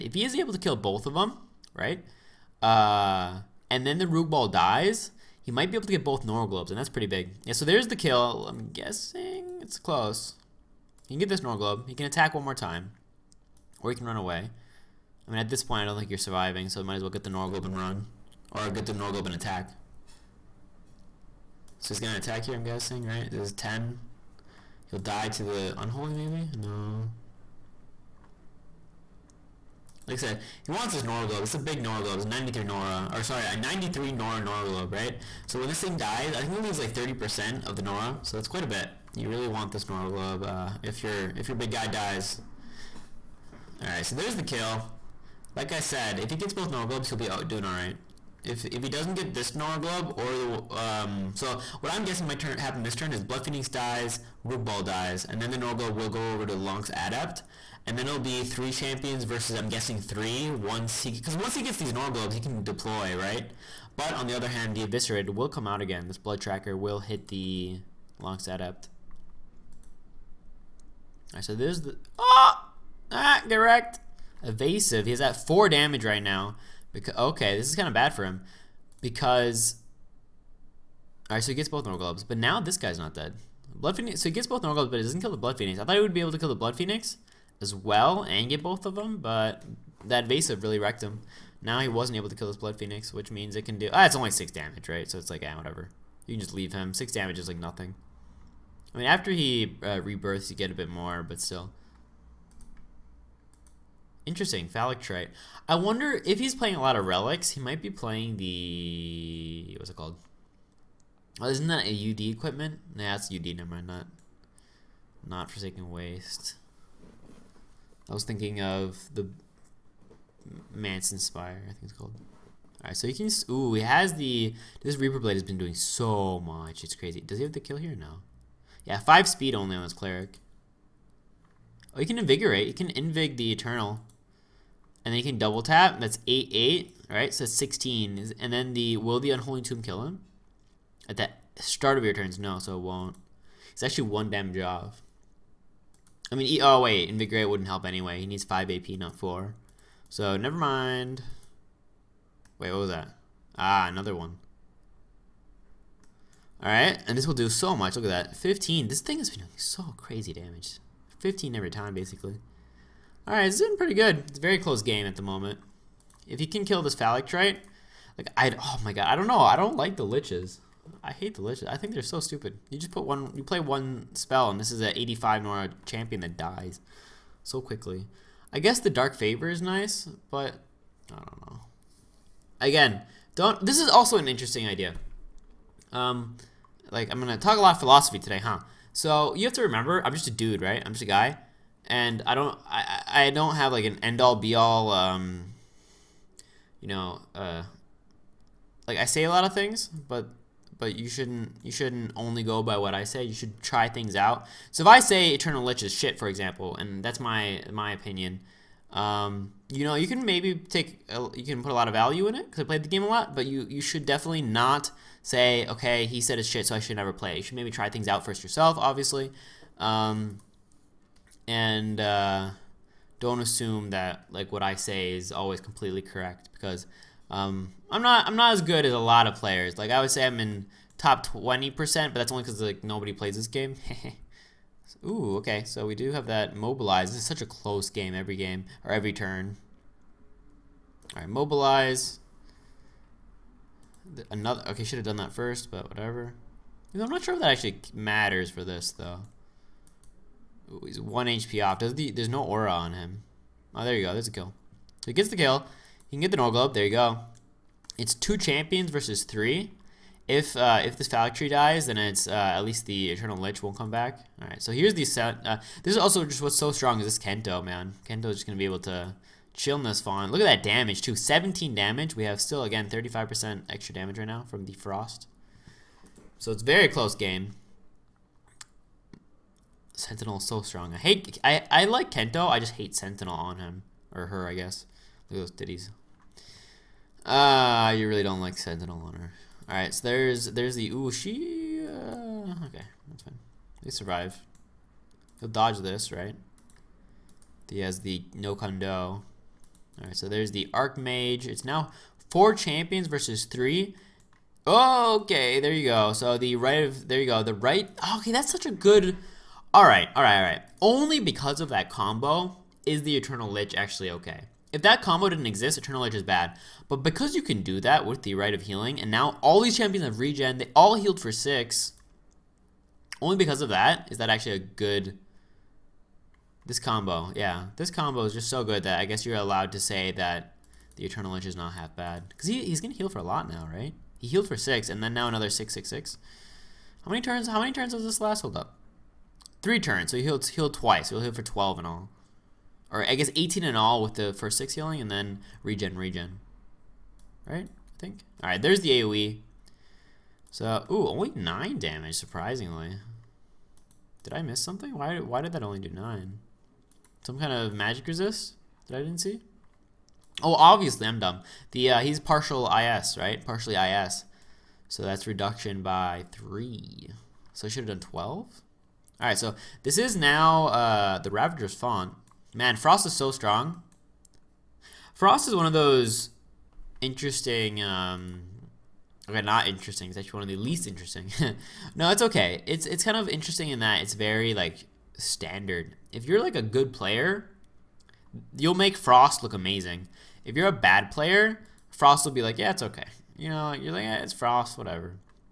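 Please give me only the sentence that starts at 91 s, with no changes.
Now he wasn't able to kill this Blood Phoenix, which means it can do...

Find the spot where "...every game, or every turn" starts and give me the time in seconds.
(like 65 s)
238 s.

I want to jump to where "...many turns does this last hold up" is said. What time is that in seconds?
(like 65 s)
337 s.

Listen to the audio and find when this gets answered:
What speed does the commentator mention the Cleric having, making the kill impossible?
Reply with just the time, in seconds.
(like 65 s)
128 s.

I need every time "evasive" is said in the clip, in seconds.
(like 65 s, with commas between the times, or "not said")
74 s, 90 s.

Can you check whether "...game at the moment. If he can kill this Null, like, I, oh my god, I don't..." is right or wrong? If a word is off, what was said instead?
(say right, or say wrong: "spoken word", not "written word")
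wrong: "Phylactery", not "Null".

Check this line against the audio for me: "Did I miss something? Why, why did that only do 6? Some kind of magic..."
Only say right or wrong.
wrong.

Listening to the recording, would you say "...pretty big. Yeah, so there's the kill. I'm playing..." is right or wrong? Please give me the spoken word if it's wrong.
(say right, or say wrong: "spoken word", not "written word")
wrong: "guessing", not "playing".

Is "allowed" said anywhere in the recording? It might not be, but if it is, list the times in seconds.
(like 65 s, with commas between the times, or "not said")
329 s.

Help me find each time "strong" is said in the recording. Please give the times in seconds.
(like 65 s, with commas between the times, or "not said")
266 s, 280 s, 373 s.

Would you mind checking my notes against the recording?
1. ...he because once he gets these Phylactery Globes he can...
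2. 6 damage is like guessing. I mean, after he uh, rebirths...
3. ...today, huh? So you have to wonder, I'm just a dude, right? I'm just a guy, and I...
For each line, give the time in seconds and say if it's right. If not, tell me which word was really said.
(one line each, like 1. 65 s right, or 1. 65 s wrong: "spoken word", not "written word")
1. 61 s wrong: "Nor", not "Phylactery"
2. 96 s wrong: "nothing", not "guessing"
3. 188 s wrong: "remember", not "wonder".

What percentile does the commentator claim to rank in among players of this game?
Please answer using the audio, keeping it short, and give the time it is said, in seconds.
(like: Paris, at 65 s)
top 20%, at 230 s.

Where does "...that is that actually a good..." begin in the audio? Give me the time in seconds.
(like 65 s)
323 s.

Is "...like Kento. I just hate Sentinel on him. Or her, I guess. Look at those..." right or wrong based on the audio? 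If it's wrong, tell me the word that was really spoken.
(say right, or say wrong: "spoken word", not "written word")
right.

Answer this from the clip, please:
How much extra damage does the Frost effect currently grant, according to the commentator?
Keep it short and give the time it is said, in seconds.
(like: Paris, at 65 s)
35%, at 272 s.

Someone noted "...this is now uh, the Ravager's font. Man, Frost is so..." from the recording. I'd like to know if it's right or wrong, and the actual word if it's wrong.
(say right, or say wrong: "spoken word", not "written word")
right.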